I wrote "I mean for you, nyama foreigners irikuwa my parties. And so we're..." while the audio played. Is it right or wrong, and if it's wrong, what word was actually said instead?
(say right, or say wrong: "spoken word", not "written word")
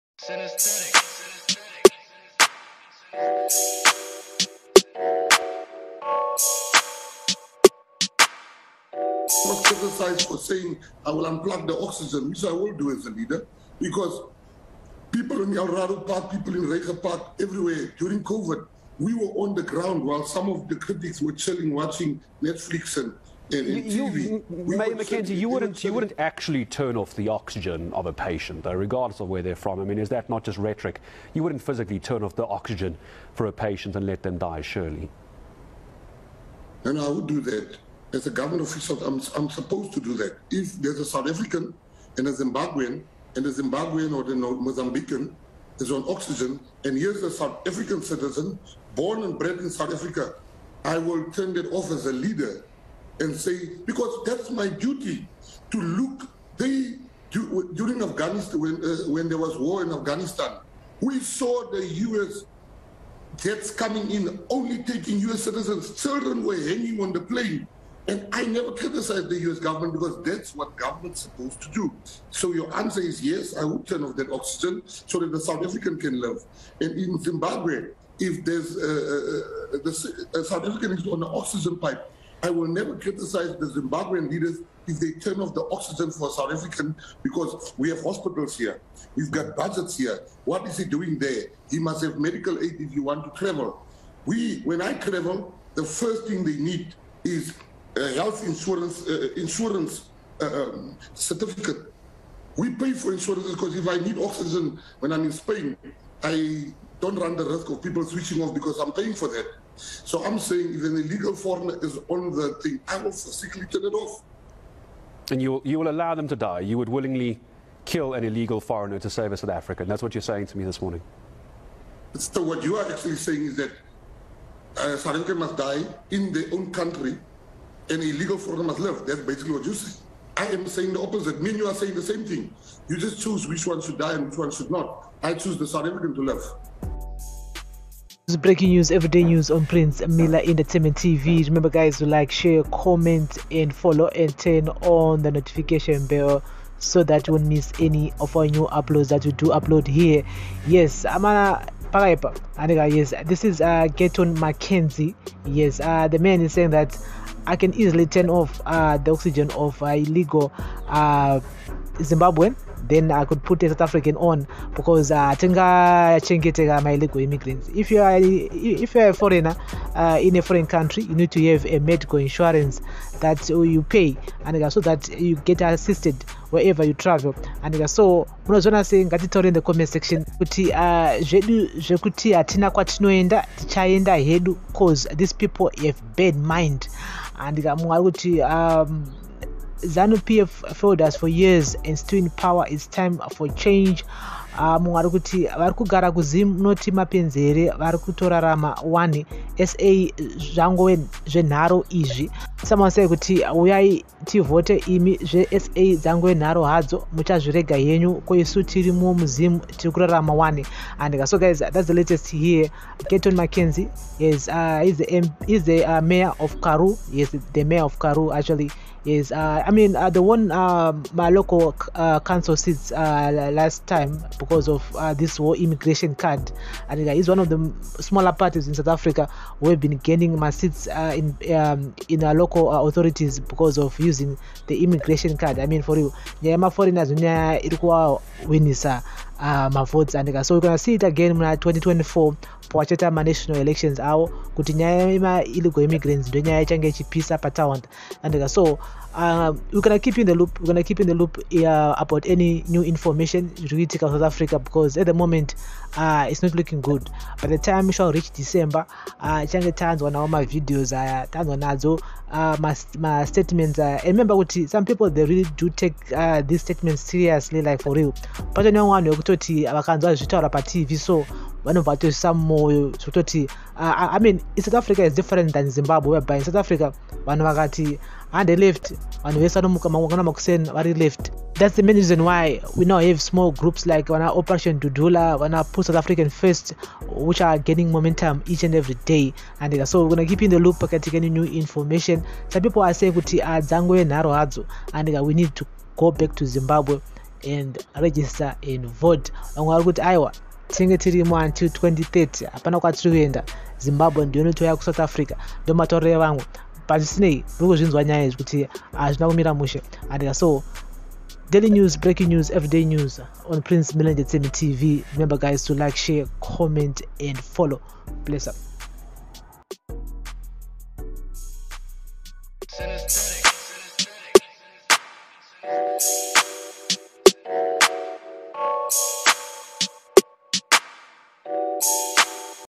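wrong: "votes", not "parties".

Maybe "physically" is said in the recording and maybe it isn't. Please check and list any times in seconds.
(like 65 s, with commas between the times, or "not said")
31 s, 113 s.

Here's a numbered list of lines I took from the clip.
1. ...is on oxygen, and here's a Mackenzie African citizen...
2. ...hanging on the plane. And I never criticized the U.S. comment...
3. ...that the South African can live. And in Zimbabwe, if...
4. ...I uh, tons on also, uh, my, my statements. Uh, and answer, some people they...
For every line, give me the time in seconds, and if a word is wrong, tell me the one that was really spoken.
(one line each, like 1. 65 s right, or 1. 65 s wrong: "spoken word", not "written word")
1. 45 s wrong: "South", not "Mackenzie"
2. 66 s wrong: "government", not "comment"
3. 75 s right
4. 260 s wrong: "remember", not "answer".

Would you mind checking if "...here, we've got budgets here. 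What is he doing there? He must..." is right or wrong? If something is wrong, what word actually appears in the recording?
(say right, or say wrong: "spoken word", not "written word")
right.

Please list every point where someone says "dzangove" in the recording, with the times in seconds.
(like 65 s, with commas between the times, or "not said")
205 s, 293 s.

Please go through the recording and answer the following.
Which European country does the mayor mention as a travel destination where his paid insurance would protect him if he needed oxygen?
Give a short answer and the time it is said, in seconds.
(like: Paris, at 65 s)
Spain, at 105 s.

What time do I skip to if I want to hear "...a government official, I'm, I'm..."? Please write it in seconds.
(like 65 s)
38 s.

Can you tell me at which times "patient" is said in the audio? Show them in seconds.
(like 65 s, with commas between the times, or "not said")
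28 s, 33 s.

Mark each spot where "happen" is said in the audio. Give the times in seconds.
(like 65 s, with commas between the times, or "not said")
not said.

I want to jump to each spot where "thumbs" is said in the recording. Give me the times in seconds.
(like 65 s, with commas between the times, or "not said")
not said.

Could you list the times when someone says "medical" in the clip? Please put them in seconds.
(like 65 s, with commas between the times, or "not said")
92 s, 171 s.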